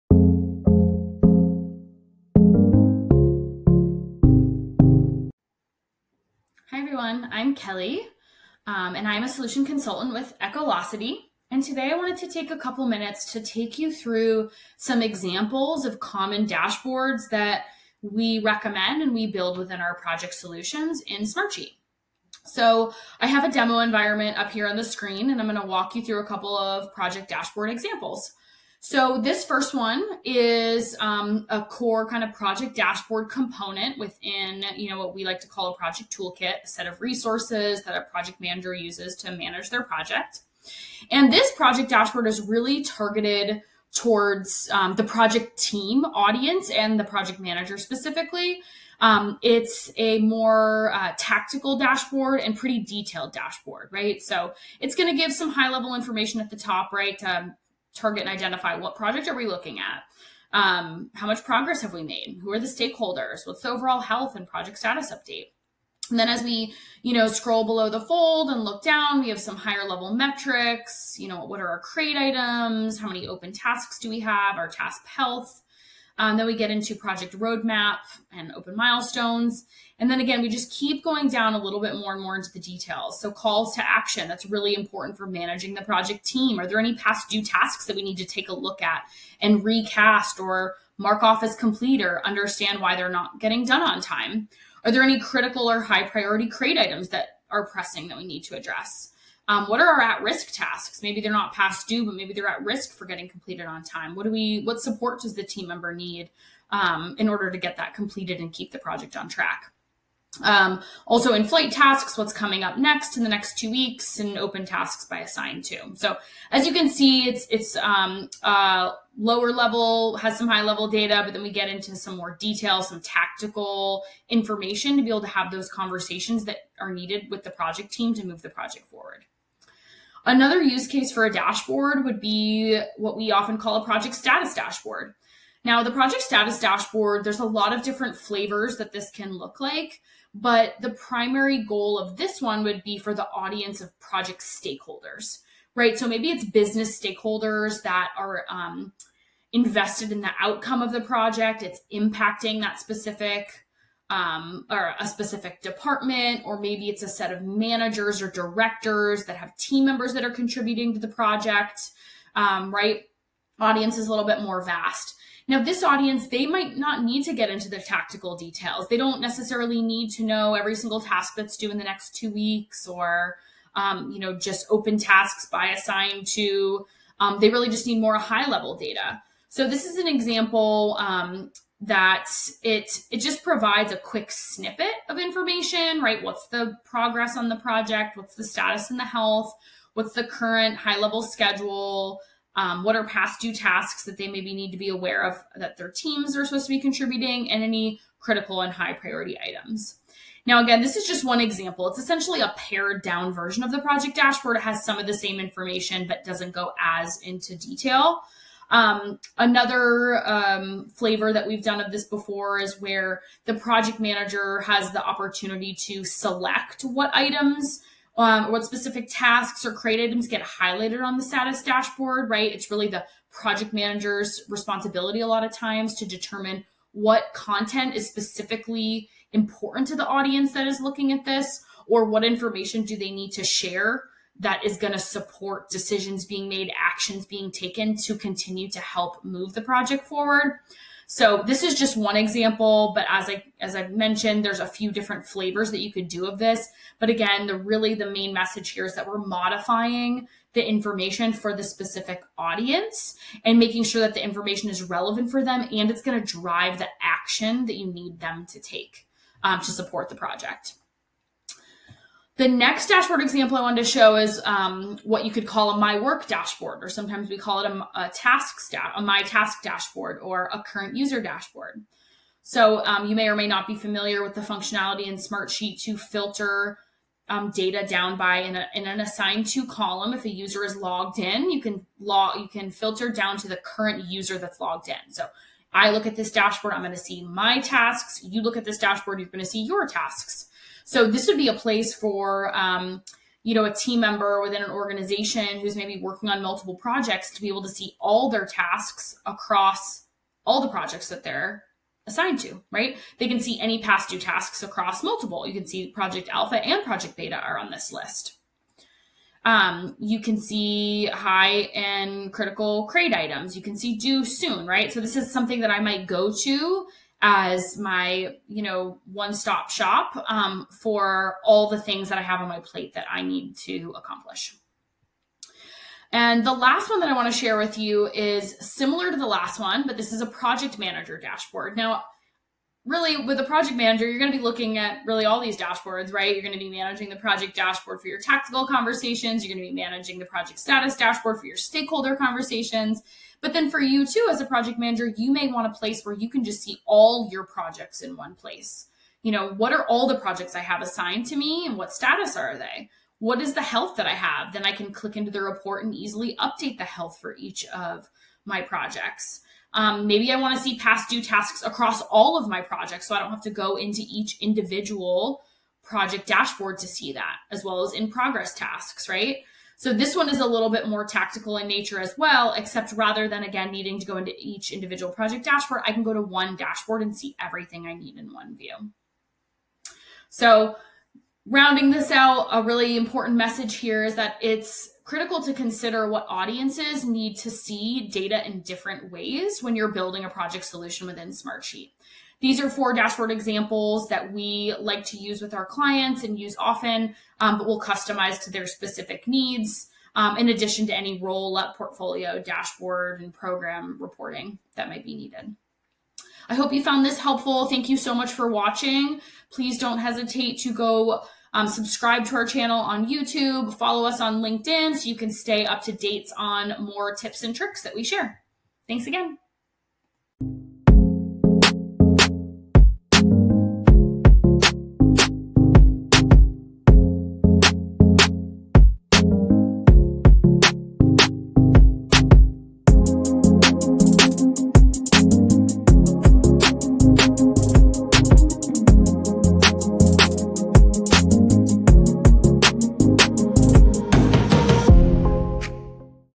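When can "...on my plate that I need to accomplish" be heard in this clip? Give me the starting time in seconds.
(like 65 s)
322 s.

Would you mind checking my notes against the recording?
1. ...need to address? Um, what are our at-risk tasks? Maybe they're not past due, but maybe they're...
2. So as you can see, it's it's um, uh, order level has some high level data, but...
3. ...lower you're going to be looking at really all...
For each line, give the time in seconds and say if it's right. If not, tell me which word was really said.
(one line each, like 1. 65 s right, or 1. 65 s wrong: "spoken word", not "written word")
1. 98 s right
2. 115 s wrong: "lower", not "order"
3. 333 s wrong: "manager", not "lower".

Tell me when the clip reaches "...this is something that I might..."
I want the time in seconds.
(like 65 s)
314 s.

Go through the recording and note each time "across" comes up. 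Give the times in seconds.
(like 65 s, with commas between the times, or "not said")
299 s, 304 s, 361 s.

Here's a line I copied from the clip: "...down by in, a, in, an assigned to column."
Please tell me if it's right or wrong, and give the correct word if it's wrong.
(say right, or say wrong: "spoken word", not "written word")
right.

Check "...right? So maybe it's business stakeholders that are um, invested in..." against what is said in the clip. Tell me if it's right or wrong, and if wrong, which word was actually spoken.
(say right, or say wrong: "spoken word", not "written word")
right.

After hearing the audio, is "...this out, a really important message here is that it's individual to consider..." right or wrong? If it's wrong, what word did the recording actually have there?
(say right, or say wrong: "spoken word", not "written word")
wrong: "critical", not "individual".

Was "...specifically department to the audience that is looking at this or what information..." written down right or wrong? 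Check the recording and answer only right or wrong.
wrong.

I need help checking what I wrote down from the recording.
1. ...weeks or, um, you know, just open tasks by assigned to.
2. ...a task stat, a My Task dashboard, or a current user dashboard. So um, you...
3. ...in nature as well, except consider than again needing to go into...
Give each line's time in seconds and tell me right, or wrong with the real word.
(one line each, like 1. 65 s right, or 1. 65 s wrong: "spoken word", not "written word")
1. 172 s right
2. 267 s right
3. 371 s wrong: "rather", not "consider".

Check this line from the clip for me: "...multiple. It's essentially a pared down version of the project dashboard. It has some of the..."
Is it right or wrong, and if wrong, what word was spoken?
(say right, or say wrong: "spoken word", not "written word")
wrong: "example", not "multiple".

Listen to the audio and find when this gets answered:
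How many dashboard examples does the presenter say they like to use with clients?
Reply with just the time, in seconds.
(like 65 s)
392 s.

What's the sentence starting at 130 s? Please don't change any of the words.
Another use case for a dashboard would be what we often call a project status dashboard.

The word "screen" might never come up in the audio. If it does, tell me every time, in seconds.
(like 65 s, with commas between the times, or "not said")
24 s.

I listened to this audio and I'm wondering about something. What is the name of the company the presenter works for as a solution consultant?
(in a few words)
Echolocity.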